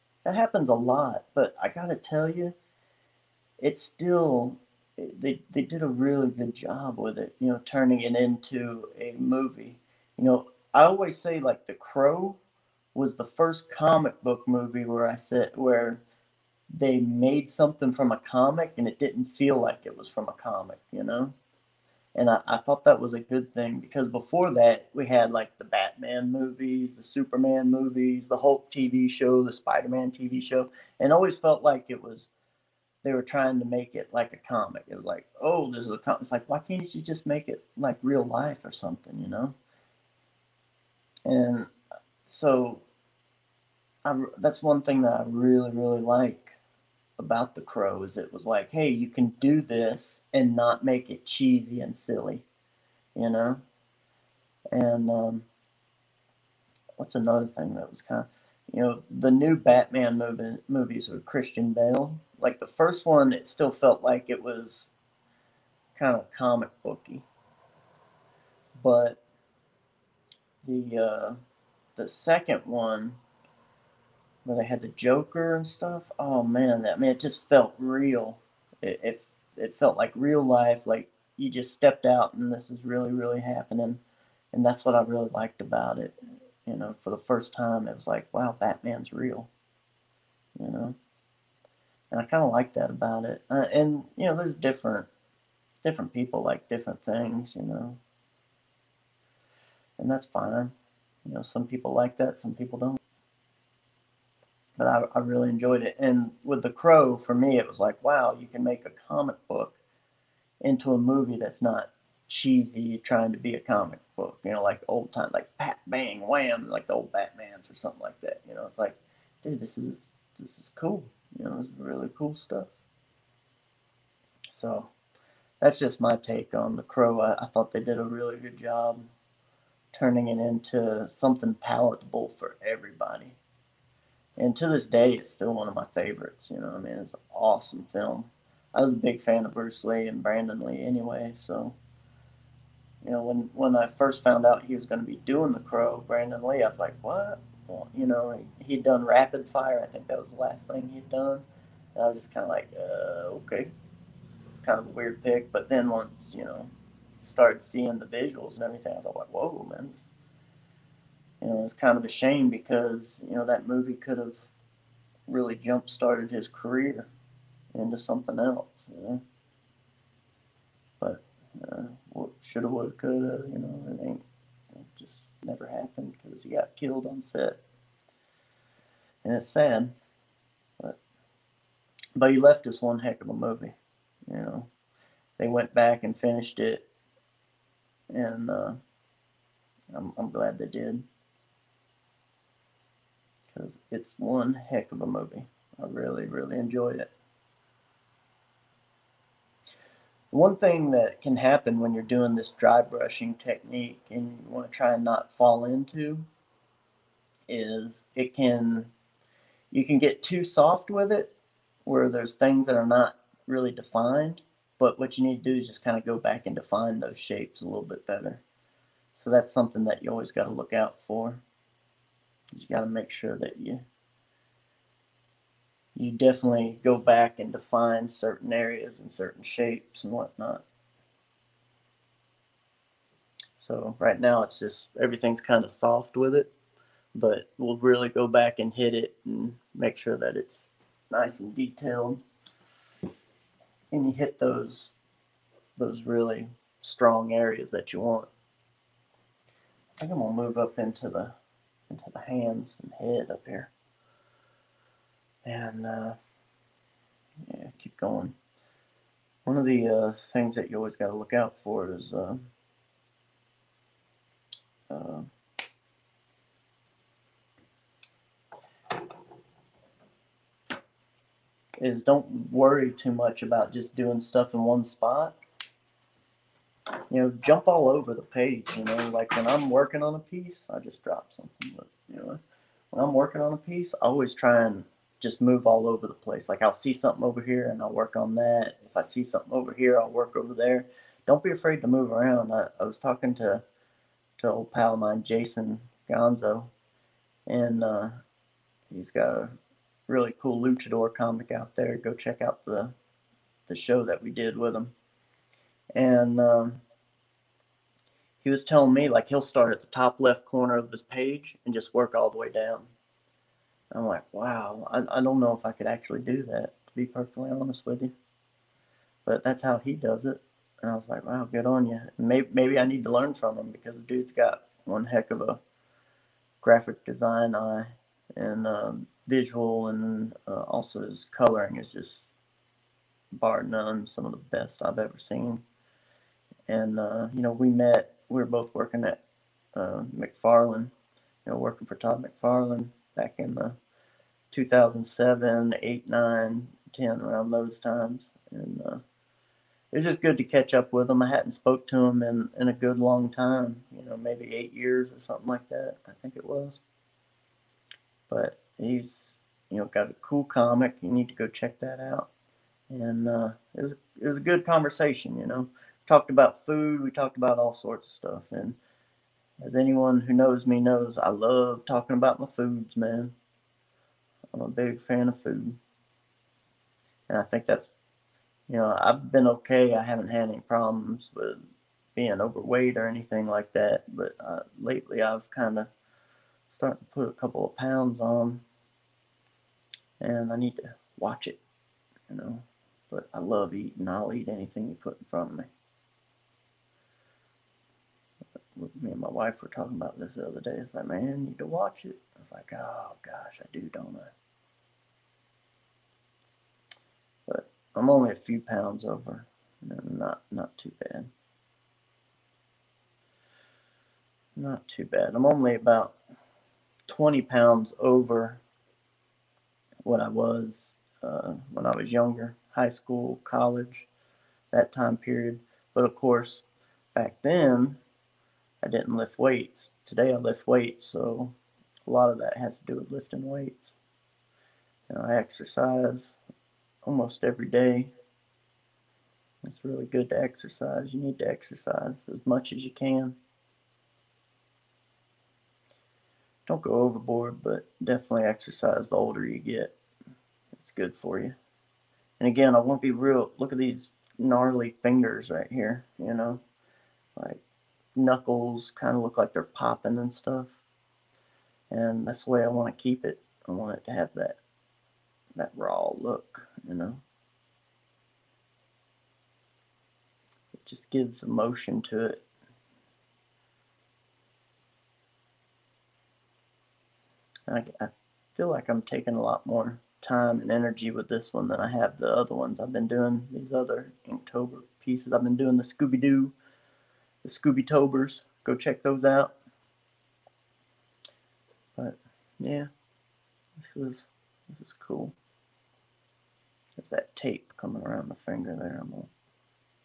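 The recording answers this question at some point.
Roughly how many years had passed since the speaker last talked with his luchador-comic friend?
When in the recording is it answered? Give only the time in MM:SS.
05:54.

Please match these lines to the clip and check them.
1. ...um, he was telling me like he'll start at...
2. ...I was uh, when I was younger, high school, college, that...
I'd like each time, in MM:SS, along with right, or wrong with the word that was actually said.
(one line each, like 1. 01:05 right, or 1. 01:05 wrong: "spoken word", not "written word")
1. 05:06 right
2. 07:00 right.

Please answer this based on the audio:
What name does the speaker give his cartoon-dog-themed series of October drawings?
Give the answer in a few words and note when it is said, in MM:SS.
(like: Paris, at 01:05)
Scooby Tobers, at 08:07.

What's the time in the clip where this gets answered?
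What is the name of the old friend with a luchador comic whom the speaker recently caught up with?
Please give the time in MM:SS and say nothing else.
04:55.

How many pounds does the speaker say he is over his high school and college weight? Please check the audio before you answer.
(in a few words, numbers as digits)
20.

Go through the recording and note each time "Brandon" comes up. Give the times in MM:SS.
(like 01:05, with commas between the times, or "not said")
02:20, 02:26.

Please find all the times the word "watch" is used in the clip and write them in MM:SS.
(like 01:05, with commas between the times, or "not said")
06:31, 06:41.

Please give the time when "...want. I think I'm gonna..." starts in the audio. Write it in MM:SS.
04:07.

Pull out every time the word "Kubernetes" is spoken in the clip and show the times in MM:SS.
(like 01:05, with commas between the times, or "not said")
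not said.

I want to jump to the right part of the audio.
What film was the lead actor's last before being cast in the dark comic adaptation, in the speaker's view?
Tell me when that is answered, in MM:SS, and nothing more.
02:29.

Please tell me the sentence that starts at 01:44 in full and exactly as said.
But I, I really enjoyed it.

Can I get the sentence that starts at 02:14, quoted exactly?
And to this day, it's still one of my favorites.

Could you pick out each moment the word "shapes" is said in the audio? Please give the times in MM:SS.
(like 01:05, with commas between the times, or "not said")
03:37, 03:49.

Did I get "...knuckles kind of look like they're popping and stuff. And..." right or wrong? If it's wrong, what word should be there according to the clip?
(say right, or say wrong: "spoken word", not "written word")
right.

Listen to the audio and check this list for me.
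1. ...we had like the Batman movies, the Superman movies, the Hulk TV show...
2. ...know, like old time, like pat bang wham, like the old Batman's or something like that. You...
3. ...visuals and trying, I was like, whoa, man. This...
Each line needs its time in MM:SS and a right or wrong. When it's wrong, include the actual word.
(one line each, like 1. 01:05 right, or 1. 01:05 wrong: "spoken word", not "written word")
1. 00:24 right
2. 01:54 right
3. 02:38 wrong: "everything", not "trying".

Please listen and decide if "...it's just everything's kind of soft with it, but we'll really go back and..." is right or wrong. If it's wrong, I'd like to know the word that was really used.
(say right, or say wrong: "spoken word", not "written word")
right.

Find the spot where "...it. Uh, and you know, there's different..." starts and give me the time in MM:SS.
01:33.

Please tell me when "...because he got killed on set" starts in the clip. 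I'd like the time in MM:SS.
02:56.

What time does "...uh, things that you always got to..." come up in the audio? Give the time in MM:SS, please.
04:19.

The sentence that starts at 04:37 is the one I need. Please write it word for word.
You know, jump all over the page.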